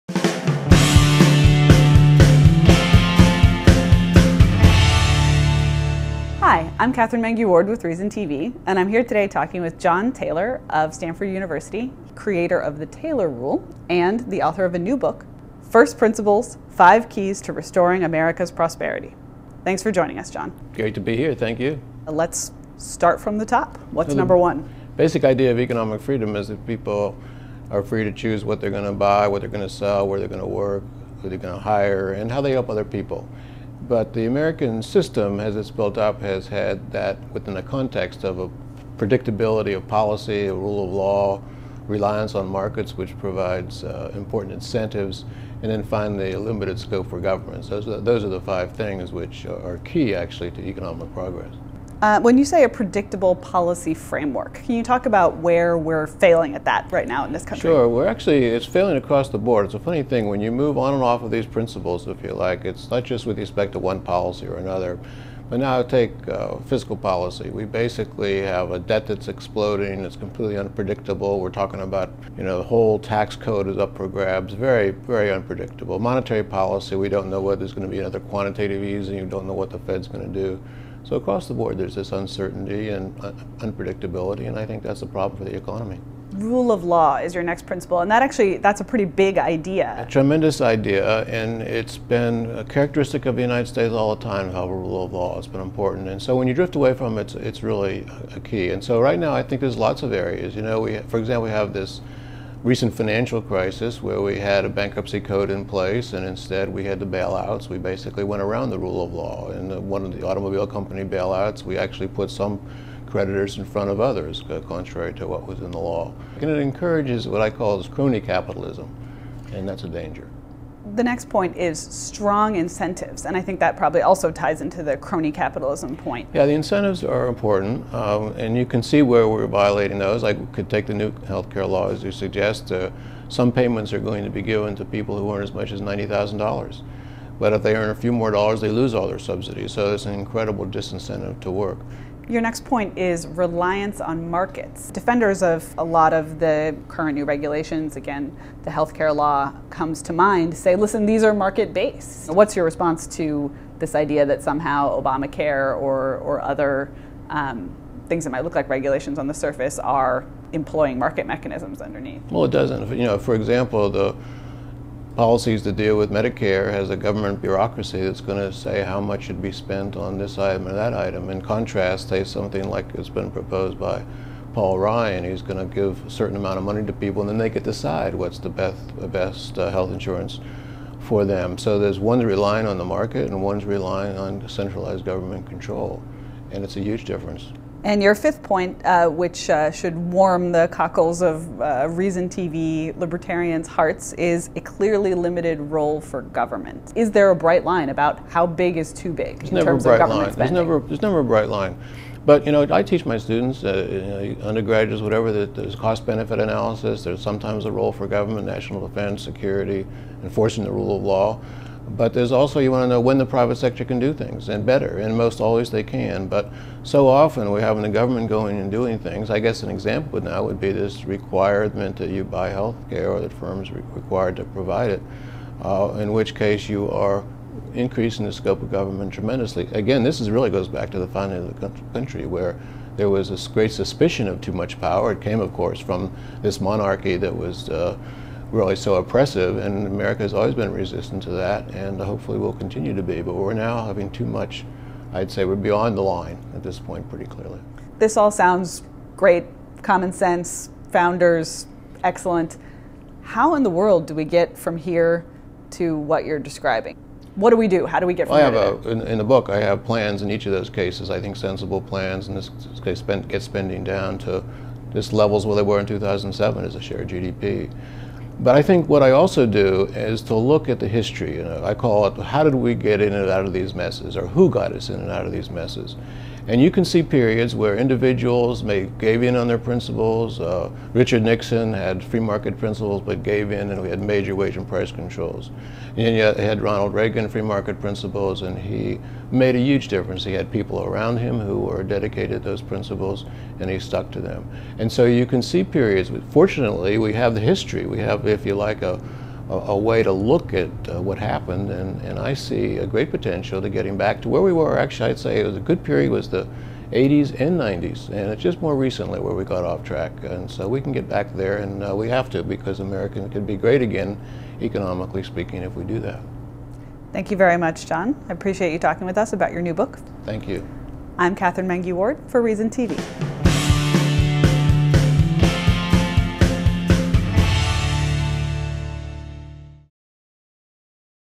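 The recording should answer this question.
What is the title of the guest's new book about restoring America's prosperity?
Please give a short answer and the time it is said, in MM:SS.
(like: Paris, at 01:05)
First Principles, at 00:15.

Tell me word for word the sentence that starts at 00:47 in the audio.
Those are, those are the five things which are key actually to economic progress.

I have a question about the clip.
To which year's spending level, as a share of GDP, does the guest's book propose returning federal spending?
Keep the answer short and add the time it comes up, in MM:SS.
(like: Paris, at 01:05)
2007, at 04:25.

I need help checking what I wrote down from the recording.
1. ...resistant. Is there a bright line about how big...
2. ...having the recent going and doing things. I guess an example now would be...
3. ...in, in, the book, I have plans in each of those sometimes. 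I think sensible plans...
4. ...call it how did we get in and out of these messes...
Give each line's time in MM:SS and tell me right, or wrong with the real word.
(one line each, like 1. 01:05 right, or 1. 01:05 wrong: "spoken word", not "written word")
1. 03:16 wrong: "government", not "resistant"
2. 03:37 wrong: "government", not "recent"
3. 04:18 wrong: "cases", not "sometimes"
4. 04:31 right.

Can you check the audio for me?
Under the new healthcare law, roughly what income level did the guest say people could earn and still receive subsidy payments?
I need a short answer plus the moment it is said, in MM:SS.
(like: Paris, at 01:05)
$90,000, at 02:15.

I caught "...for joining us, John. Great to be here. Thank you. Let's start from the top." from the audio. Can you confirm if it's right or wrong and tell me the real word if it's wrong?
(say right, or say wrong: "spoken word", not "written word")
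right.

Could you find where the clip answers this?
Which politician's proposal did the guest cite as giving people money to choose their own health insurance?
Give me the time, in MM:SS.
02:54.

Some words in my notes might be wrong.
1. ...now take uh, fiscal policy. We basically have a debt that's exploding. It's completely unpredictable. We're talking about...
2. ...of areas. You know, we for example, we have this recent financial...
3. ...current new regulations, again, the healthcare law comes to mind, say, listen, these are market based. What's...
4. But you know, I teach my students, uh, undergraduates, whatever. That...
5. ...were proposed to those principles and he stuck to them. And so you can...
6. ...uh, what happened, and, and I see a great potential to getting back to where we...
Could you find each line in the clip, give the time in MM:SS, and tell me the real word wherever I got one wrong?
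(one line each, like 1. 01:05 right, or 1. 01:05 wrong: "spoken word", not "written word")
1. 01:05 right
2. 01:40 right
3. 02:26 right
4. 03:22 right
5. 04:51 wrong: "dedicated", not "proposed"
6. 05:00 right.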